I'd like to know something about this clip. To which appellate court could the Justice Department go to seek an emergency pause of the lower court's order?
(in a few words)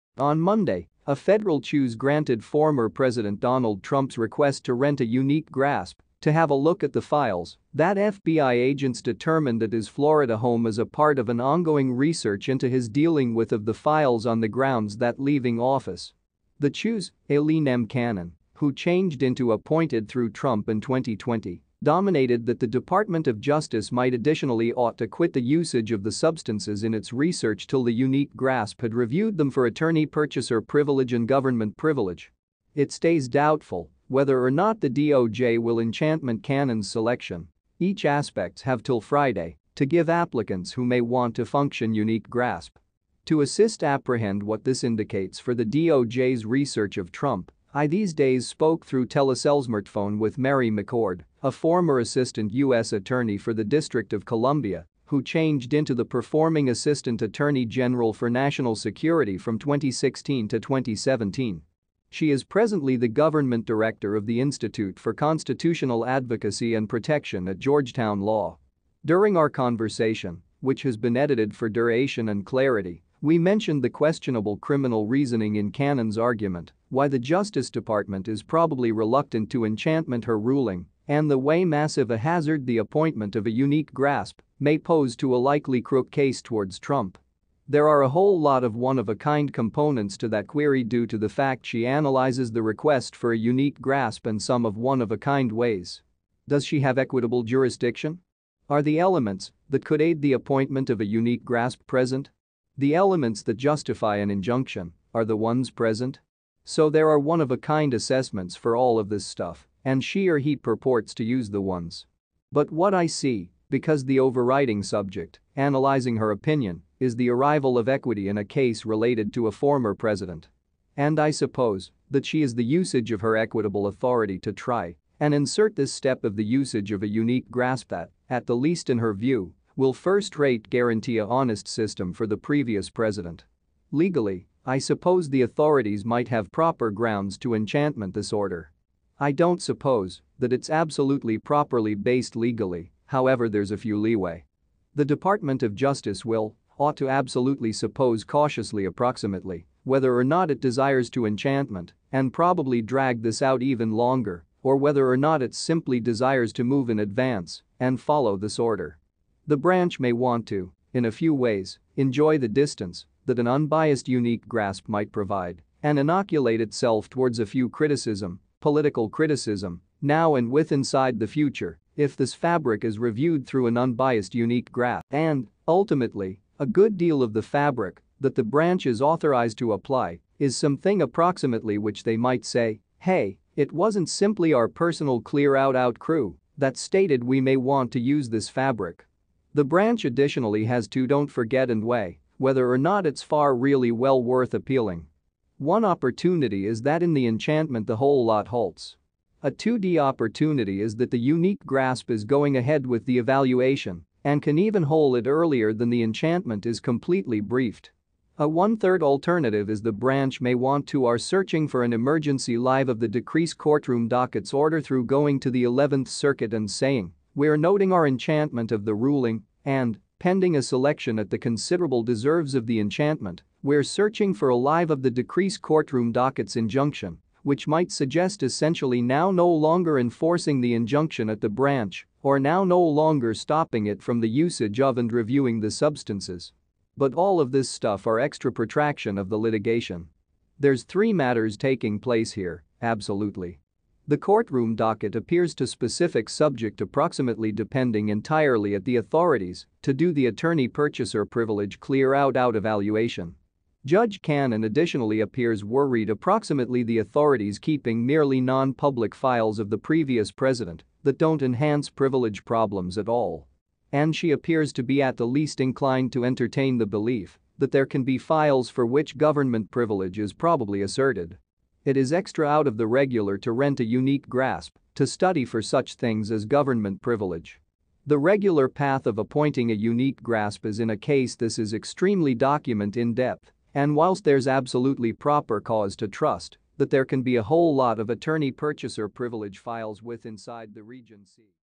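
11th circuit.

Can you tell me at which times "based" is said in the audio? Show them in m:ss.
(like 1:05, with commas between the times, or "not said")
2:21.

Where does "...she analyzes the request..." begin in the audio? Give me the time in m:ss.
1:31.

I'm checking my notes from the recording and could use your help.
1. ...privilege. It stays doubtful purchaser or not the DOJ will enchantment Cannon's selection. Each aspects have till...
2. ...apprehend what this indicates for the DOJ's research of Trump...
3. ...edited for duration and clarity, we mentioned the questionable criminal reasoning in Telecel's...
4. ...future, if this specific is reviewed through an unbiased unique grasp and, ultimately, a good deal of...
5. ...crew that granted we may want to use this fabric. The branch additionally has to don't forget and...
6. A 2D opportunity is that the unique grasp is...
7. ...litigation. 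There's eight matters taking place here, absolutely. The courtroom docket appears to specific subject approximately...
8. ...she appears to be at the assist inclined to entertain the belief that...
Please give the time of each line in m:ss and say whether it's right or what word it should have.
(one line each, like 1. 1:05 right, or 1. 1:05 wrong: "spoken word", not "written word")
1. 0:31 wrong: "whether", not "purchaser"
2. 0:43 right
3. 1:11 wrong: "Cannon", not "Telecel"
4. 2:51 wrong: "fabric", not "specific"
5. 3:05 wrong: "stated", not "granted"
6. 3:19 right
7. 3:59 wrong: "three", not "eight"
8. 4:24 wrong: "least", not "assist".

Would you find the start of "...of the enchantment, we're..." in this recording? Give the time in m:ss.
3:42.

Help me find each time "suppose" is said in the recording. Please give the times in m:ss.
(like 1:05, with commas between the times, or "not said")
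2:01, 2:14, 2:19, 2:27.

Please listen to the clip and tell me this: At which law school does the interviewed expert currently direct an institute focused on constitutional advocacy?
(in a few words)
Georgetown Law.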